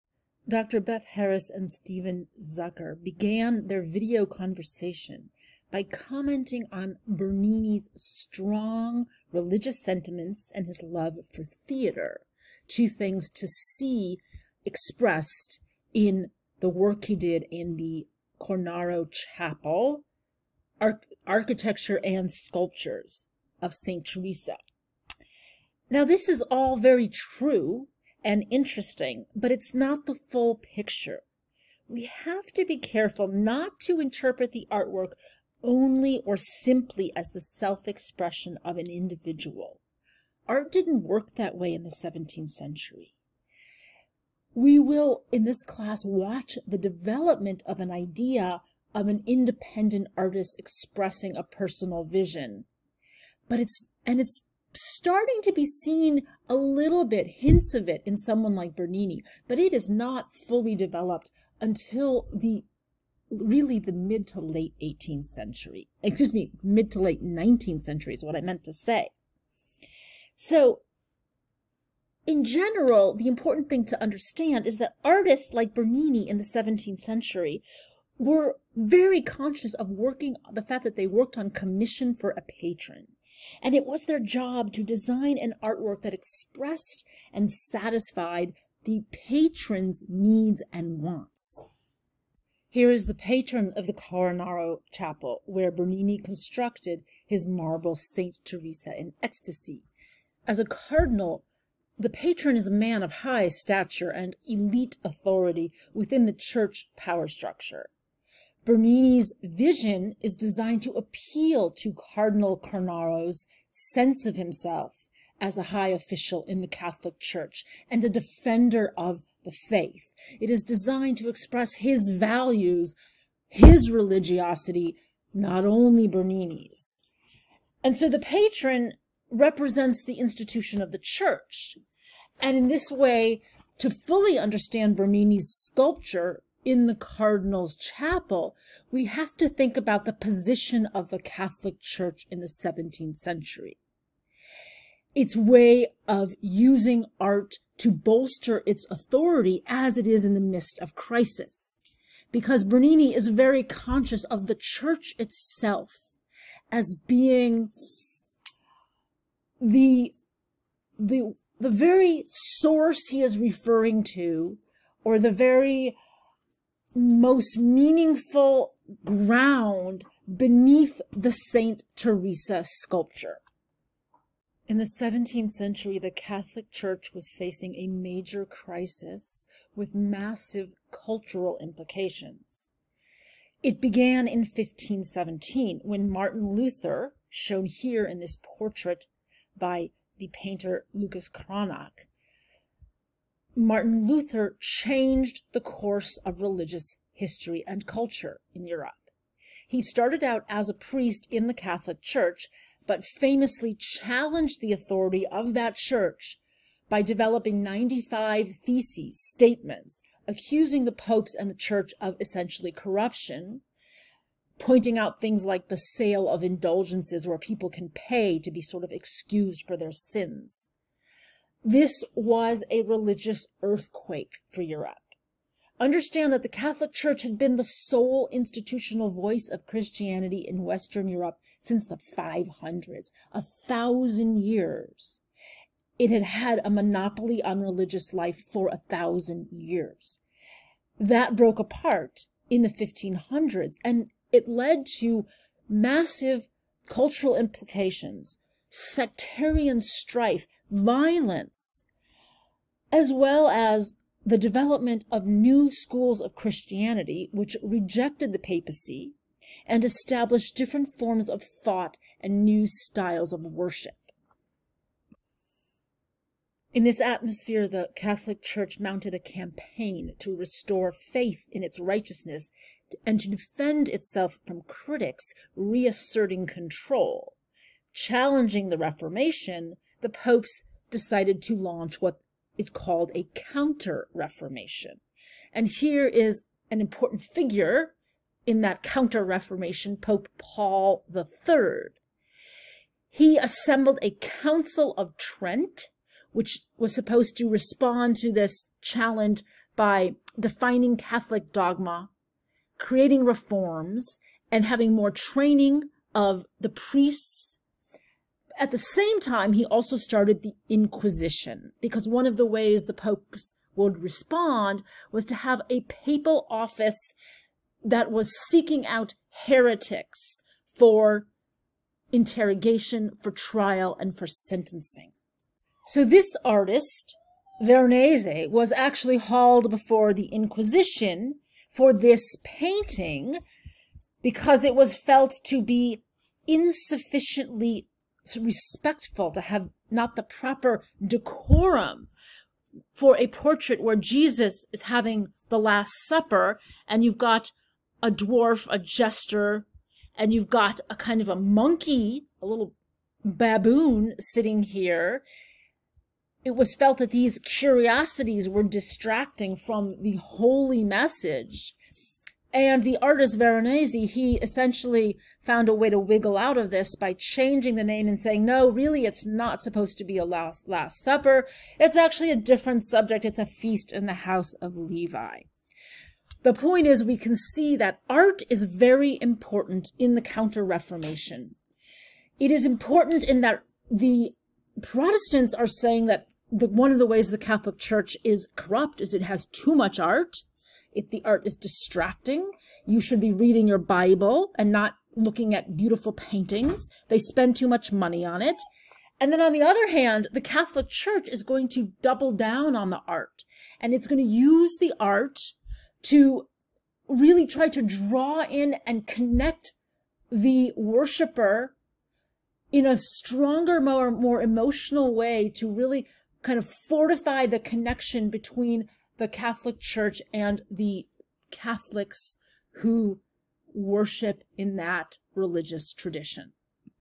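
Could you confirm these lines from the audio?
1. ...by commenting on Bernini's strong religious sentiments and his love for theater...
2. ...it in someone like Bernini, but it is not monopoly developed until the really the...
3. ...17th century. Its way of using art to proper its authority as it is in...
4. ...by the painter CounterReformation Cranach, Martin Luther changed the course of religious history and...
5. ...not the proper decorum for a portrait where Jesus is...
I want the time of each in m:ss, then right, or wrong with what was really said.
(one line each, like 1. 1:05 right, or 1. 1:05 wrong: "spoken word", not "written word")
1. 0:05 right
2. 0:57 wrong: "fully", not "monopoly"
3. 2:22 wrong: "bolster", not "proper"
4. 3:09 wrong: "Lucas", not "CounterReformation"
5. 5:39 right.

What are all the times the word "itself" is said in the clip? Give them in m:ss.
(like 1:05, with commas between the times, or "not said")
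2:35, 4:33.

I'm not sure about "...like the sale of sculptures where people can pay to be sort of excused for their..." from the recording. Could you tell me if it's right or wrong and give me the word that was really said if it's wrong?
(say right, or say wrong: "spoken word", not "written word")
wrong: "indulgences", not "sculptures".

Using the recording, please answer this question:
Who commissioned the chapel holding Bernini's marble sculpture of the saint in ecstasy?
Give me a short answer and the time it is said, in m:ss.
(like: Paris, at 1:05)
Cardinal Cornaro, at 1:52.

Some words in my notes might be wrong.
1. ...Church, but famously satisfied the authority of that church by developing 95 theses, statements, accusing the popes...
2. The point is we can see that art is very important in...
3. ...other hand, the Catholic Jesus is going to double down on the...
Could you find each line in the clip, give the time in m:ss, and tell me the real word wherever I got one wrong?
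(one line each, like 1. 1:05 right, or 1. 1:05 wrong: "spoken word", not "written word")
1. 3:22 wrong: "challenged", not "satisfied"
2. 6:16 right
3. 6:39 wrong: "Church", not "Jesus".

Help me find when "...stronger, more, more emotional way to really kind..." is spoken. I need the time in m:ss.
6:52.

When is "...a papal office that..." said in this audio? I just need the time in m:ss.
5:15.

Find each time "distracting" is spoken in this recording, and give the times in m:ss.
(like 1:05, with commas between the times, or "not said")
5:58, 6:31.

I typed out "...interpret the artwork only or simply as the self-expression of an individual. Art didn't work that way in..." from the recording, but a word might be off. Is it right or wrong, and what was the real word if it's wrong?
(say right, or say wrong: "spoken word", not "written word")
right.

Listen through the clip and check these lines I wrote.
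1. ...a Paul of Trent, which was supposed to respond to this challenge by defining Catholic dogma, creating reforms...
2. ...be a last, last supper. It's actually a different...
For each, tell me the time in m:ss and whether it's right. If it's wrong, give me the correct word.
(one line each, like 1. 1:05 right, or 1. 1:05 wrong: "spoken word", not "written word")
1. 4:54 wrong: "Council", not "Paul"
2. 6:10 right.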